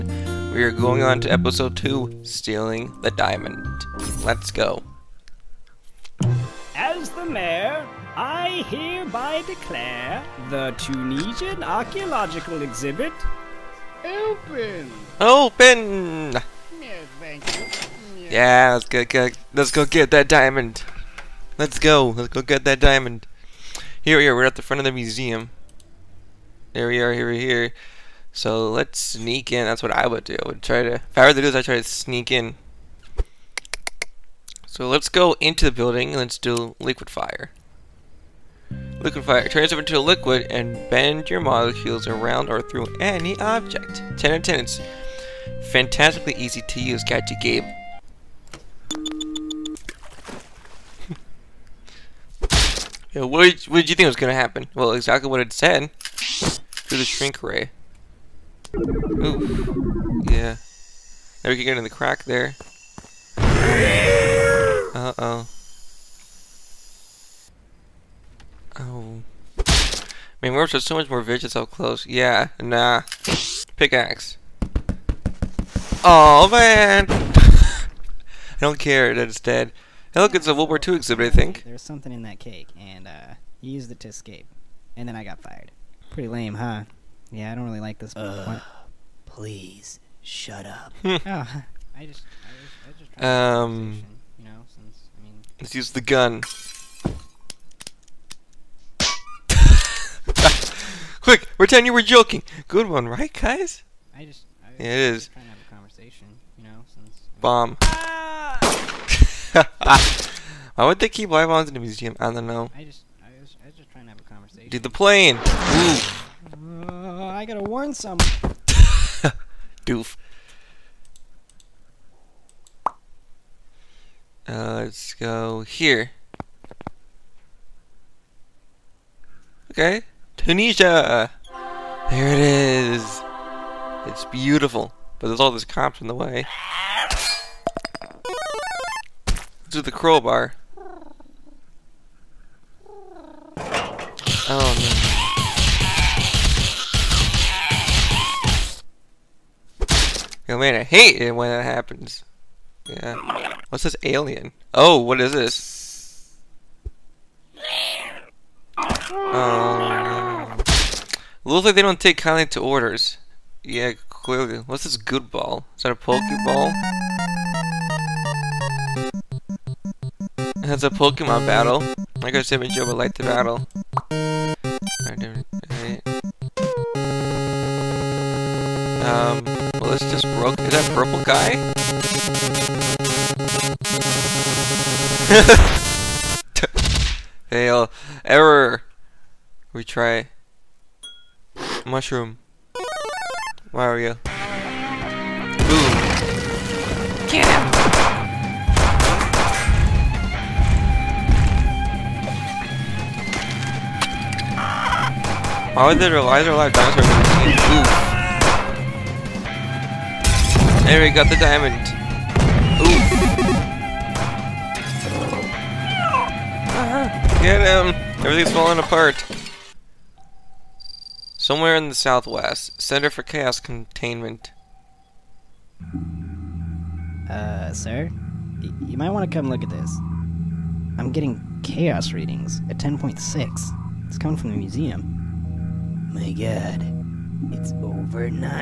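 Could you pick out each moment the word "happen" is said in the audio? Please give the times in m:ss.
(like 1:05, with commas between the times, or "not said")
0:54, 2:31.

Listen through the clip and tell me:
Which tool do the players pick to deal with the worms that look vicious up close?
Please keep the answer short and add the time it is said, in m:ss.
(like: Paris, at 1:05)
Pickaxe, at 1:13.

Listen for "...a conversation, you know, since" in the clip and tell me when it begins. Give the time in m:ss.
1:45.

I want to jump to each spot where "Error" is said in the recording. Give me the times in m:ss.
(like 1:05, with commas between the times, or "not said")
3:08.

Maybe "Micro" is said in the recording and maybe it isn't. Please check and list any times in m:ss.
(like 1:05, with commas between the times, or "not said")
2:52.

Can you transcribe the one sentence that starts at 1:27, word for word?
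Yeah, I don't really like this.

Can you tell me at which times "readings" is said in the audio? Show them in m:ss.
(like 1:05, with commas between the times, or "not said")
3:52.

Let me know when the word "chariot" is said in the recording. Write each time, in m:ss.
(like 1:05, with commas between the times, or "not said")
not said.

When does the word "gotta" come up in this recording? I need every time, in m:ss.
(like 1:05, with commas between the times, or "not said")
1:57.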